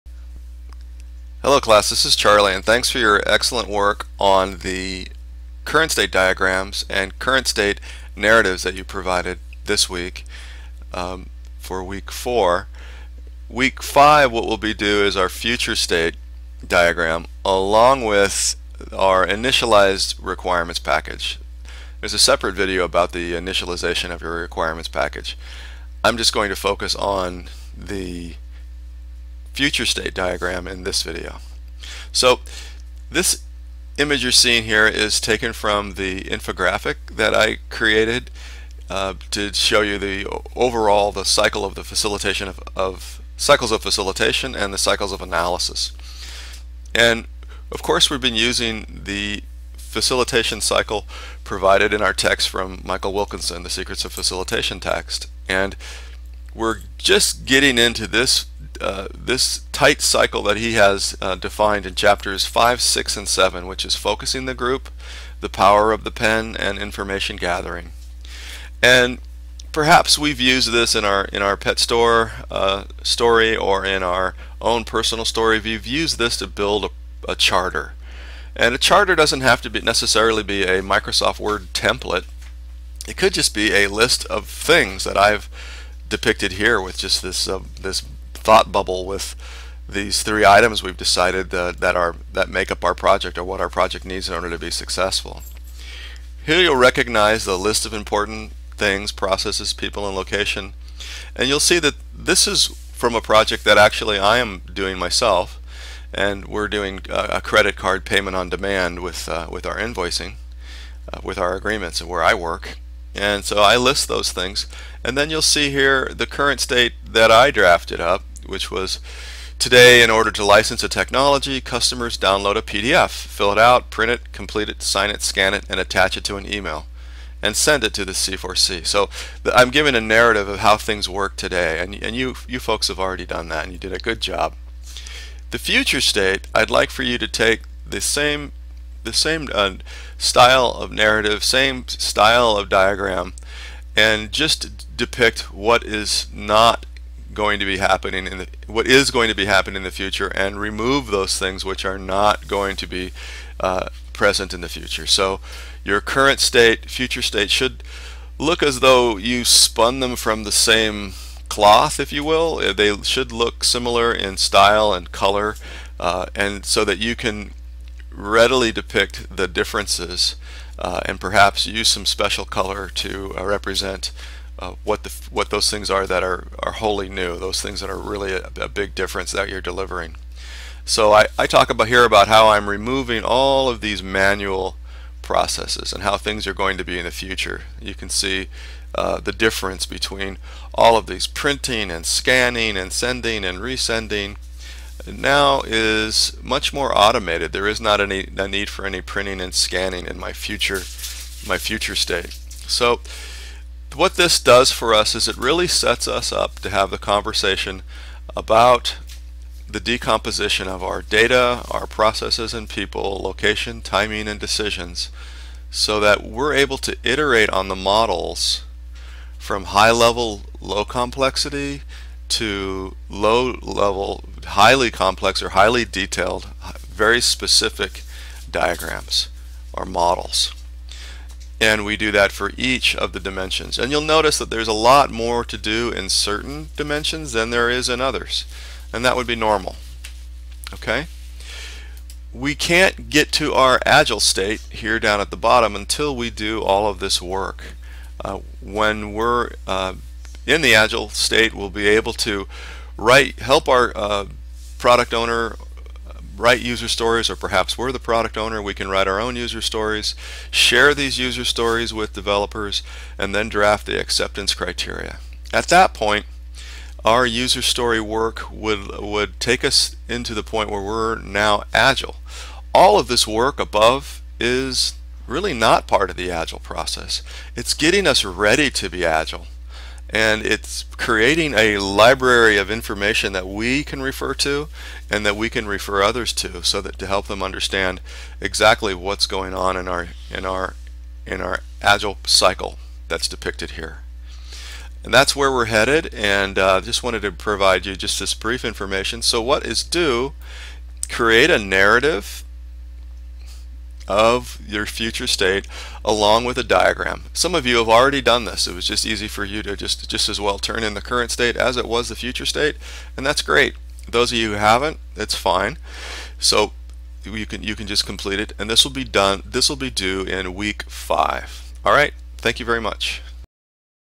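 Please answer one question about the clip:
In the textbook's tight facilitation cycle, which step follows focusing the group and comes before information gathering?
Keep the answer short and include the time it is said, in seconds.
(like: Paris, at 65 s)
the power of the pen, at 65 s.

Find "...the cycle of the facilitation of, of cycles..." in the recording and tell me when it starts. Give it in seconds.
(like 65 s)
41 s.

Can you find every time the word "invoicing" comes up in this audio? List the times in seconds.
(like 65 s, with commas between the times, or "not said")
109 s.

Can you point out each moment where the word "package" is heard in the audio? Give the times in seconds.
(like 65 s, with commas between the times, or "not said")
20 s, 24 s.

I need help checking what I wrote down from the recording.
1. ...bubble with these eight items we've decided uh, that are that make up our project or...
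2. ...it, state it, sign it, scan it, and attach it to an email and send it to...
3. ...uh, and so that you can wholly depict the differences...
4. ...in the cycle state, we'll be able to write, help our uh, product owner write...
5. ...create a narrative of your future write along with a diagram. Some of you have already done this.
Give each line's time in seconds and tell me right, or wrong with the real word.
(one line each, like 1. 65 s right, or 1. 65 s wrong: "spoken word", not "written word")
1. 88 s wrong: "three", not "eight"
2. 124 s wrong: "complete", not "state"
3. 165 s wrong: "readily", not "wholly"
4. 250 s wrong: "agile", not "cycle"
5. 301 s wrong: "state", not "write".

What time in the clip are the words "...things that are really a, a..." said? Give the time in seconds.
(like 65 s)
177 s.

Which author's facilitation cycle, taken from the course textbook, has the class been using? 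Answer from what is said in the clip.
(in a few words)
Michael Wilkinson.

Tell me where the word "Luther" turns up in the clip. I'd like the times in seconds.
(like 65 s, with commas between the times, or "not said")
not said.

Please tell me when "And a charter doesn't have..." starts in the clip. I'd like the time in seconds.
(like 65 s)
78 s.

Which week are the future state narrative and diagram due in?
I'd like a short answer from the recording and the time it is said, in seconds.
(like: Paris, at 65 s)
week 5, at 320 s.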